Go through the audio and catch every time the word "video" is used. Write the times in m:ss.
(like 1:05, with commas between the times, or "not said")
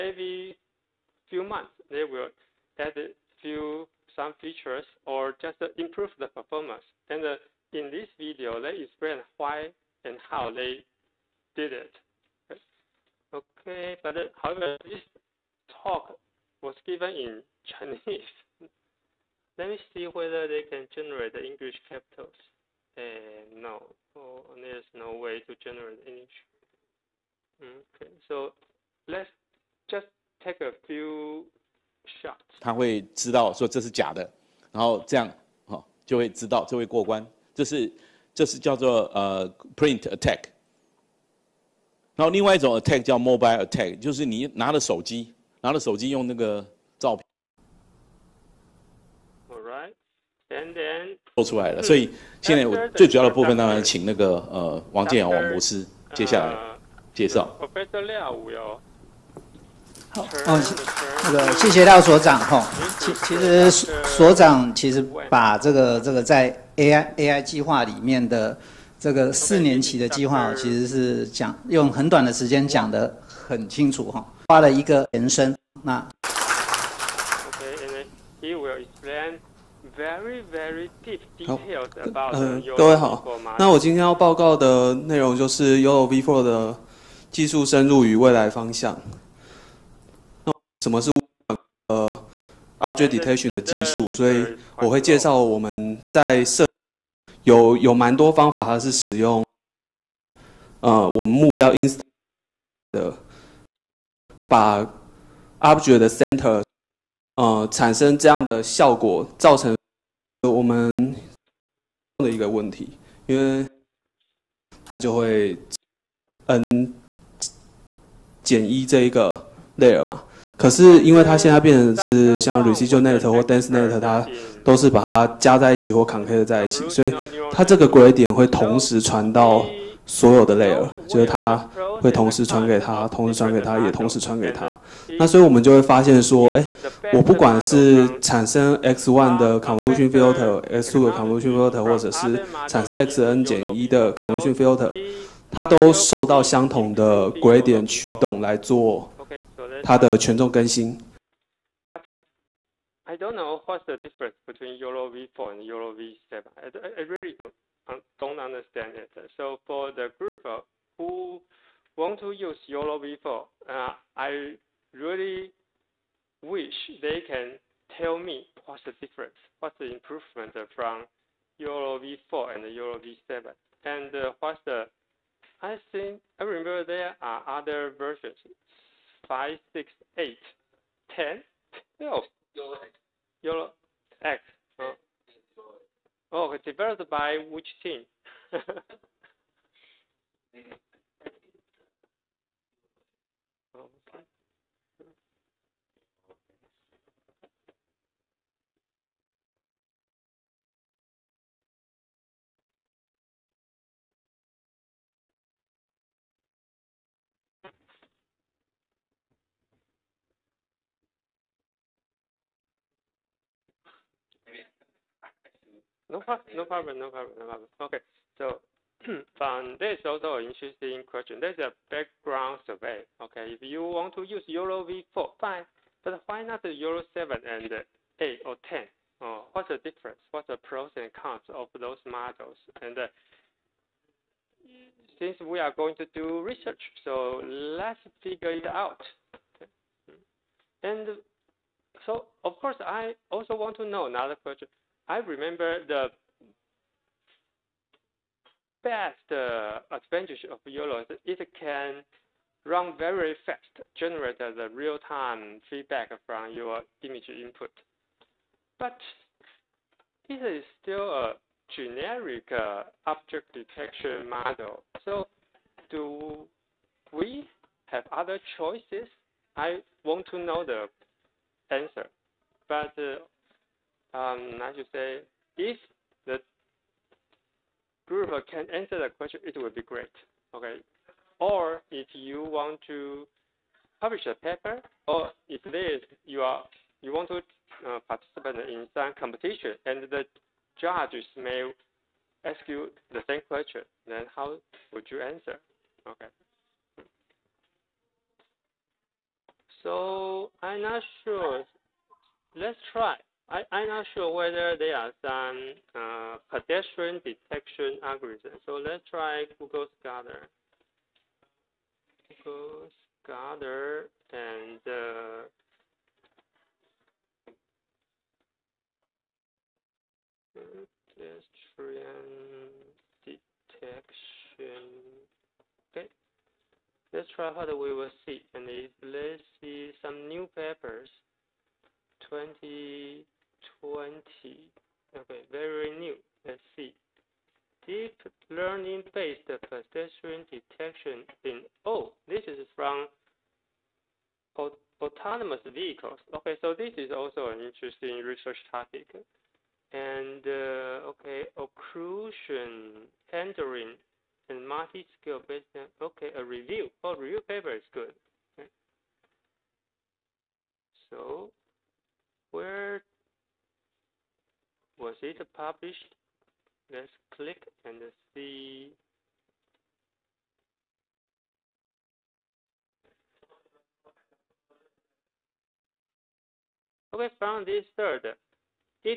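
0:08.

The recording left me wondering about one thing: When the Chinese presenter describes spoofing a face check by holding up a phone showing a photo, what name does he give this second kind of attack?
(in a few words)
mobile attack.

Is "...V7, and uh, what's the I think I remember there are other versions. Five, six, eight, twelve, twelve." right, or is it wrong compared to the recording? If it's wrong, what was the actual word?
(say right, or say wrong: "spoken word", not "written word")
wrong: "ten", not "twelve".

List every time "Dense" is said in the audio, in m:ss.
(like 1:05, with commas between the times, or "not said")
2:03.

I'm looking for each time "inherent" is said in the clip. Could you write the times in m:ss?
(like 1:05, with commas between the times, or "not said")
not said.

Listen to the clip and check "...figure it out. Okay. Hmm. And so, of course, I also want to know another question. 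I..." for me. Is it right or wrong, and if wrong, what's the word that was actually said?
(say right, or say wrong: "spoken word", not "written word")
right.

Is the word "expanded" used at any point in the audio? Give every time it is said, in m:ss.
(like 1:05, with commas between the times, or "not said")
not said.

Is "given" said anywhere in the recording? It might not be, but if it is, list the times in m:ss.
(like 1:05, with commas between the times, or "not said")
0:16.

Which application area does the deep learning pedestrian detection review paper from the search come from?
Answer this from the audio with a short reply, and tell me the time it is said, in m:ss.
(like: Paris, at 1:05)
autonomous vehicles, at 5:45.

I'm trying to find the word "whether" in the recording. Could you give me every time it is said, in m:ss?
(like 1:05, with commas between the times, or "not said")
0:20, 5:04.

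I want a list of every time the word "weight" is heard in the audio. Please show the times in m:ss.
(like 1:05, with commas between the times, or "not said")
not said.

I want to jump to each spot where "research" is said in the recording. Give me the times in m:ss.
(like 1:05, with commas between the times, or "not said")
3:56, 5:48.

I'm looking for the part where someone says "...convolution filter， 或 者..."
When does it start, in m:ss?
2:21.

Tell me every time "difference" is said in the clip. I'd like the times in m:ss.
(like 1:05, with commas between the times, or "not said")
2:33, 2:49, 3:49.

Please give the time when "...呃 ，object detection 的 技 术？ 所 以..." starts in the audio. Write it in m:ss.
1:31.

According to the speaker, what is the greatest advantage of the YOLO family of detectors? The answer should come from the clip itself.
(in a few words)
run very fast.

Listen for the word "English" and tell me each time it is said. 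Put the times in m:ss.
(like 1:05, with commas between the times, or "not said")
0:21, 0:26.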